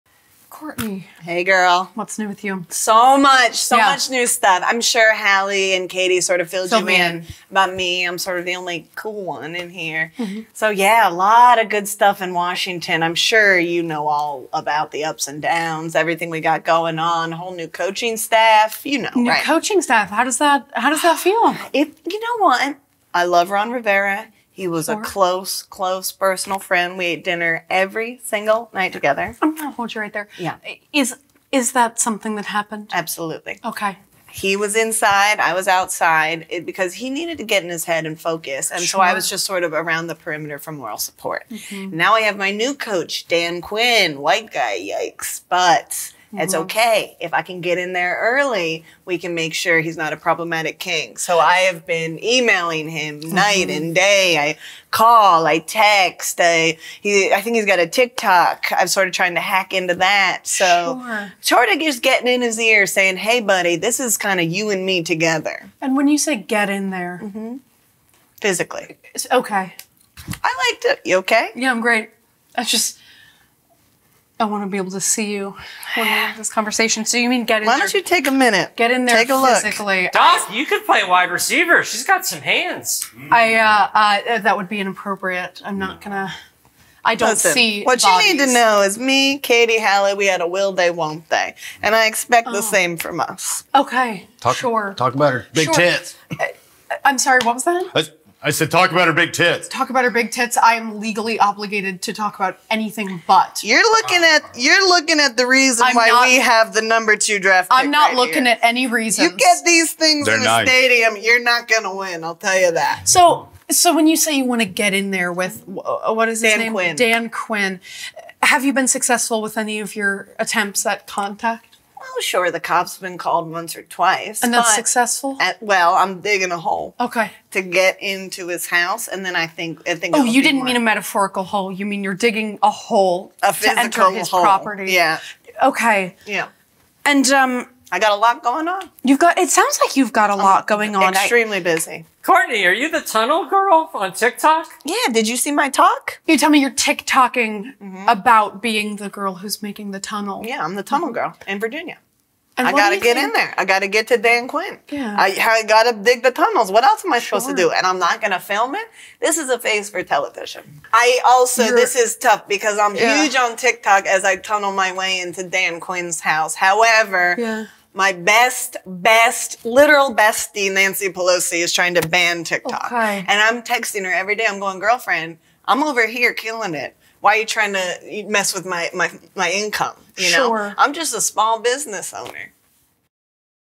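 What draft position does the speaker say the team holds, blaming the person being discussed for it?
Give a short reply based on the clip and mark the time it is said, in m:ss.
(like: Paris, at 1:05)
number two, at 1:46.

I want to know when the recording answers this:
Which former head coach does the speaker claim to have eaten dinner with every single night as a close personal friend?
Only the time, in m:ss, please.
0:23.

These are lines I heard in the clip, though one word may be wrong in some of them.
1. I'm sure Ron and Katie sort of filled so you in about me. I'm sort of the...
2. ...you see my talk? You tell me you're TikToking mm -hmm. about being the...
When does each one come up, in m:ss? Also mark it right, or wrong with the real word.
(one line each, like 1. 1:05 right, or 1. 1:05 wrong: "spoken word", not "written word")
1. 0:04 wrong: "Hallie", not "Ron"
2. 2:25 right.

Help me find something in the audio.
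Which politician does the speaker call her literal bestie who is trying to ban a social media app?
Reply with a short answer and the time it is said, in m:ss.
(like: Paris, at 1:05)
Nancy Pelosi, at 2:50.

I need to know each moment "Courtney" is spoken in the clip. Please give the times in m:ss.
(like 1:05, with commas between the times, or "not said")
0:00, 2:22.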